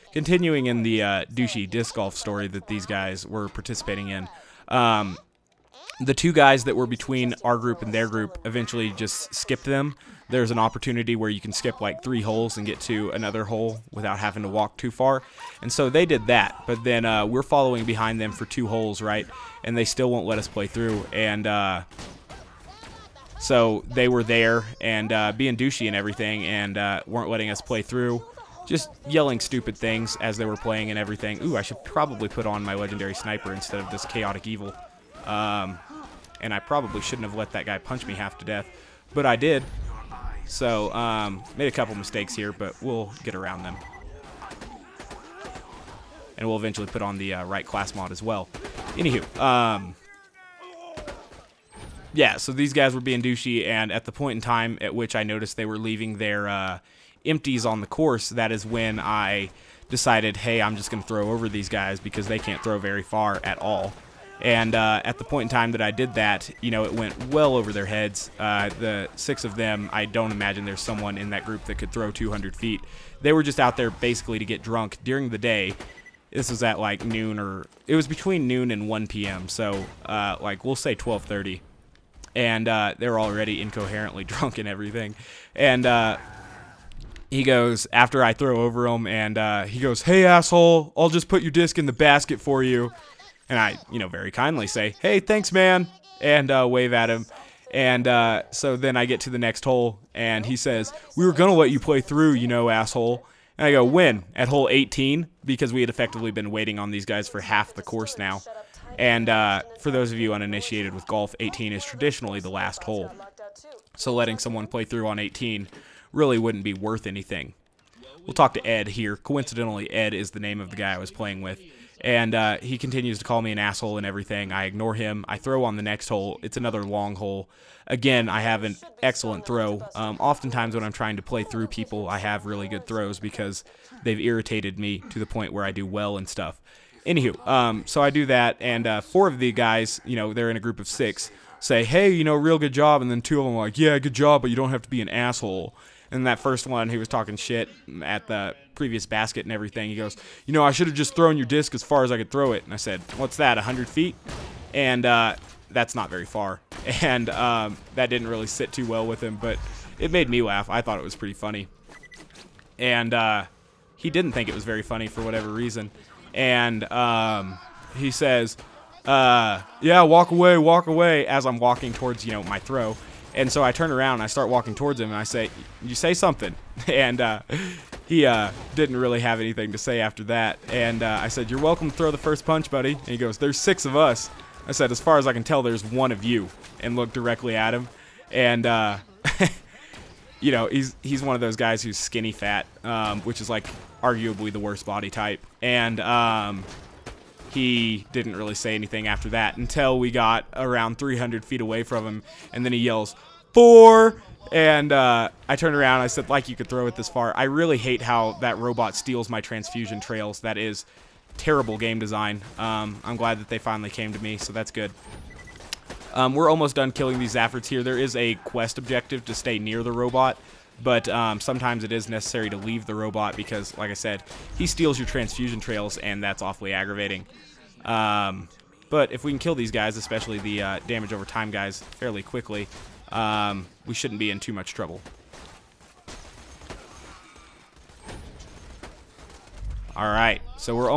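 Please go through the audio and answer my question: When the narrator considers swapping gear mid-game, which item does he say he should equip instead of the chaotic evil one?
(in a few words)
legendary sniper.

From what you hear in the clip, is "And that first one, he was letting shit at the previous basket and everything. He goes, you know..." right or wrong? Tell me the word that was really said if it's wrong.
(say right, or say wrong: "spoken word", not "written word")
wrong: "talking", not "letting".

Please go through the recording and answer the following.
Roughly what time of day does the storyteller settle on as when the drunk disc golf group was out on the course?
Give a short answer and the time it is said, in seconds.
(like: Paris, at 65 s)
12:30, at 80 s.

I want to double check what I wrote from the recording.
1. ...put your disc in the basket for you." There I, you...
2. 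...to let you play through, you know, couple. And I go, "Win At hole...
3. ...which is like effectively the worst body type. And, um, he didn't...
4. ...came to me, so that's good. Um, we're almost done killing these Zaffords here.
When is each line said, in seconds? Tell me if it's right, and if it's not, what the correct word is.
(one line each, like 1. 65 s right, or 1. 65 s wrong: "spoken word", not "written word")
1. 91 s wrong: "And", not "There"
2. 101 s wrong: "asshole", not "couple"
3. 193 s wrong: "arguably", not "effectively"
4. 213 s right.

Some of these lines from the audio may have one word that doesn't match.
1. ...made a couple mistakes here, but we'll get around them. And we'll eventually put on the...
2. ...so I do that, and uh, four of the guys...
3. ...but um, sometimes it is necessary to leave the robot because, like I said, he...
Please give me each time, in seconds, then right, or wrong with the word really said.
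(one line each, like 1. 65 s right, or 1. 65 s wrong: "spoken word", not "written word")
1. 41 s right
2. 137 s right
3. 220 s right.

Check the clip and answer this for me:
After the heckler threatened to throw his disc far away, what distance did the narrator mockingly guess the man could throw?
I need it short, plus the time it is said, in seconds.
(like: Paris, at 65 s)
100 feet, at 153 s.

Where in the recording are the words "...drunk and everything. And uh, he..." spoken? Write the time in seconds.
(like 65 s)
84 s.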